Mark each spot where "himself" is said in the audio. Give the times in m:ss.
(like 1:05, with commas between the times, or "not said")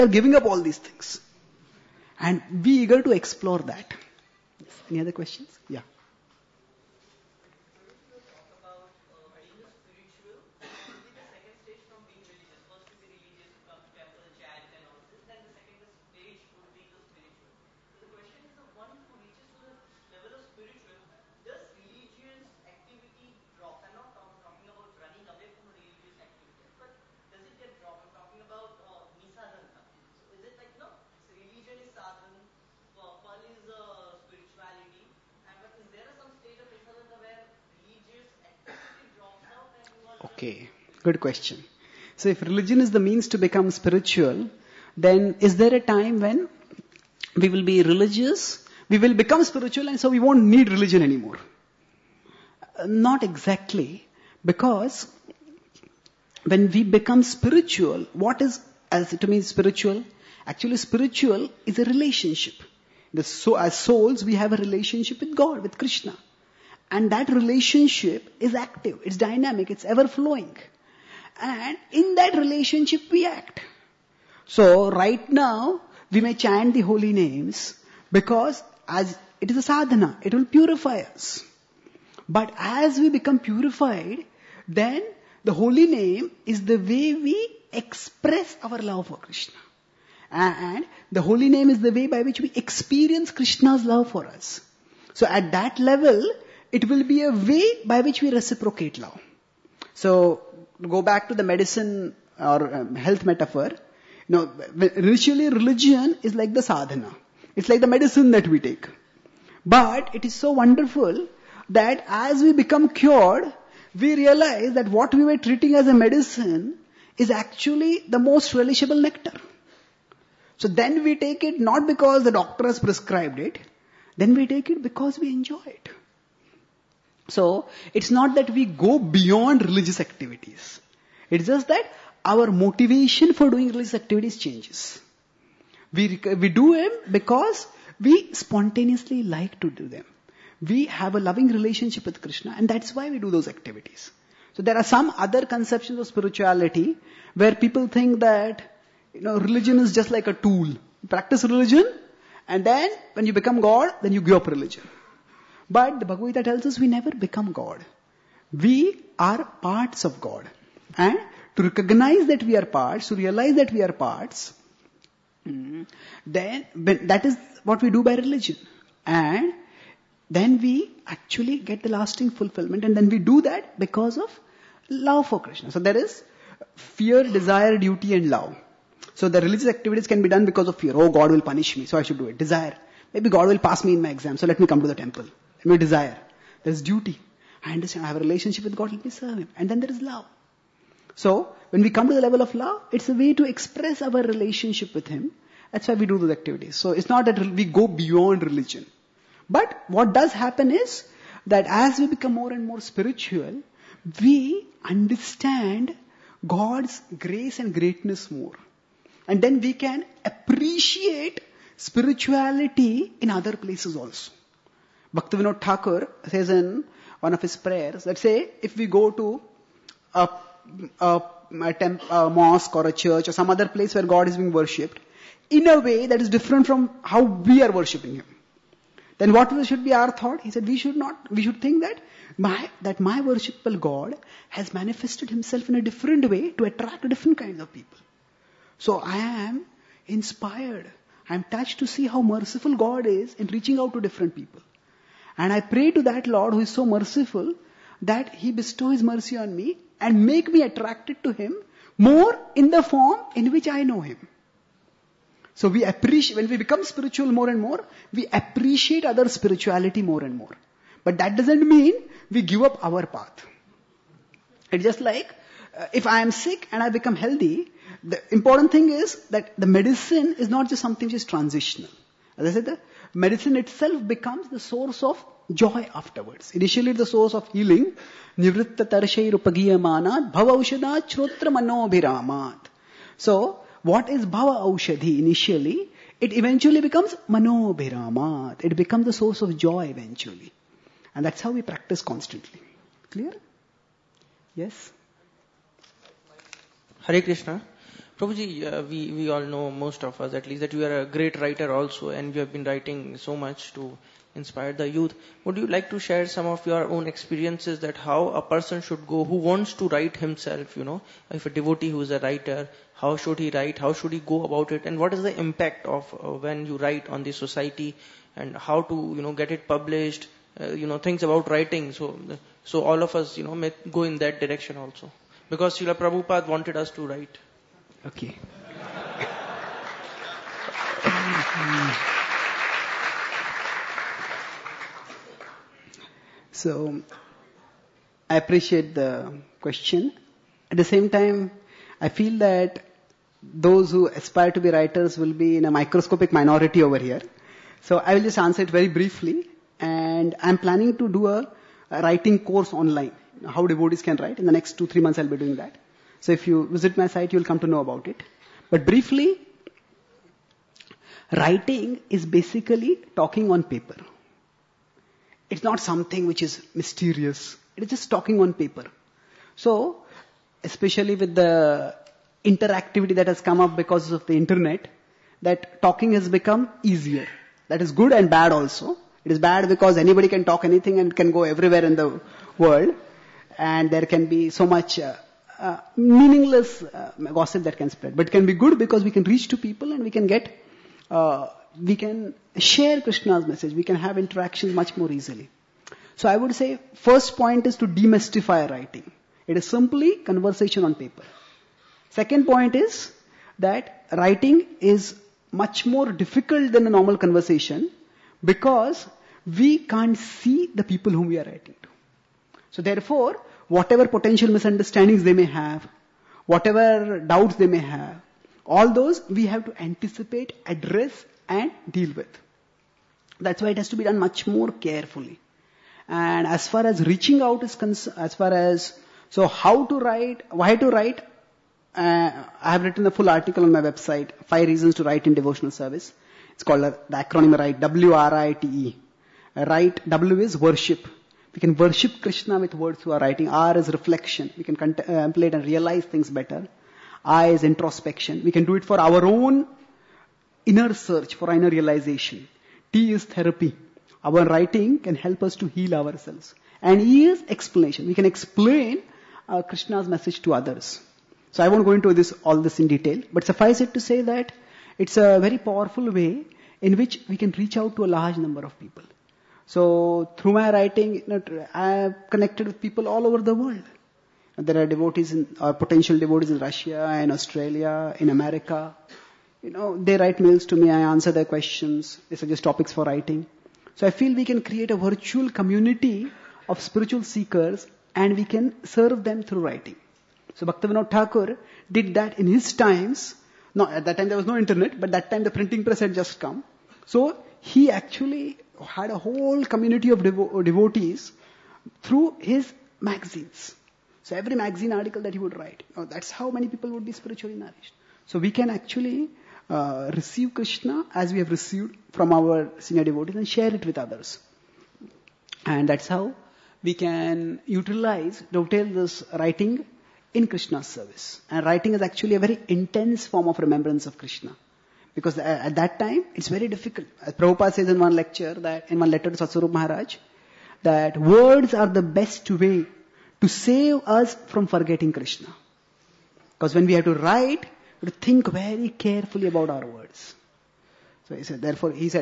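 3:55, 5:10.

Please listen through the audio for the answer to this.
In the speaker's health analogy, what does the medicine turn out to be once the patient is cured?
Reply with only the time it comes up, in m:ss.
1:58.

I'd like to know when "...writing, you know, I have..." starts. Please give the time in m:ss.
7:50.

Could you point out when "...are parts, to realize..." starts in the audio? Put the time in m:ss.
2:42.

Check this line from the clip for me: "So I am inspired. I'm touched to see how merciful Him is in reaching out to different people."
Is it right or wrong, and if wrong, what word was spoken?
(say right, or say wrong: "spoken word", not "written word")
wrong: "God", not "Him".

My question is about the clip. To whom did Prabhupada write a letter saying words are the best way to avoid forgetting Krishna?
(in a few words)
Satsvarup Maharaj.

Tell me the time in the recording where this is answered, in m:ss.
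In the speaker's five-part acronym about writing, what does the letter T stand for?
7:33.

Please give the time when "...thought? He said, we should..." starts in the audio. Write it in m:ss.
3:50.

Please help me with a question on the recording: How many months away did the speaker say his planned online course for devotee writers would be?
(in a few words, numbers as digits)
2 to 3 months.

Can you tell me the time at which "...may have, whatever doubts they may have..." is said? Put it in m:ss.
6:55.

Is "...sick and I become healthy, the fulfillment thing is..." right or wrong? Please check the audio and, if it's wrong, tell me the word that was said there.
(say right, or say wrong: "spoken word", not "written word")
wrong: "important", not "fulfillment".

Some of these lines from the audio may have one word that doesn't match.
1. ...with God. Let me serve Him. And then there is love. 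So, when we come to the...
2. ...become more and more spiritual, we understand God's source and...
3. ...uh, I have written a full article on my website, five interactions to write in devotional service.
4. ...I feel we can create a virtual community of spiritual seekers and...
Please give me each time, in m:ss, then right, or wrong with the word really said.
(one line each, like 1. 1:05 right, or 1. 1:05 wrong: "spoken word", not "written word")
1. 3:08 right
2. 3:22 wrong: "grace", not "source"
3. 7:11 wrong: "reasons", not "interactions"
4. 8:04 right.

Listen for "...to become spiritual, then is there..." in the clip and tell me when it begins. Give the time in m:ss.
0:43.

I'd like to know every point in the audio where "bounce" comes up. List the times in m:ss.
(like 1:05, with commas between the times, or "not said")
not said.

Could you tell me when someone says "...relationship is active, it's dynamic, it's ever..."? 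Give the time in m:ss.
1:07.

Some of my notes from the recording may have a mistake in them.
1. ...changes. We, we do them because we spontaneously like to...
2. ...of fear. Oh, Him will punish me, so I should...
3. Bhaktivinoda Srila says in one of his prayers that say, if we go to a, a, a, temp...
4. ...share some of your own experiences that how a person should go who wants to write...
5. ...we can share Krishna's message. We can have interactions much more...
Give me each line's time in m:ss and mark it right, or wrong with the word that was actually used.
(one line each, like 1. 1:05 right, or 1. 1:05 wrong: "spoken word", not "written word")
1. 2:14 right
2. 3:00 wrong: "God", not "Him"
3. 3:35 wrong: "Thakur", not "Srila"
4. 5:05 right
5. 6:31 right.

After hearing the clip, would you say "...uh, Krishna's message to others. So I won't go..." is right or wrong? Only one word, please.
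right.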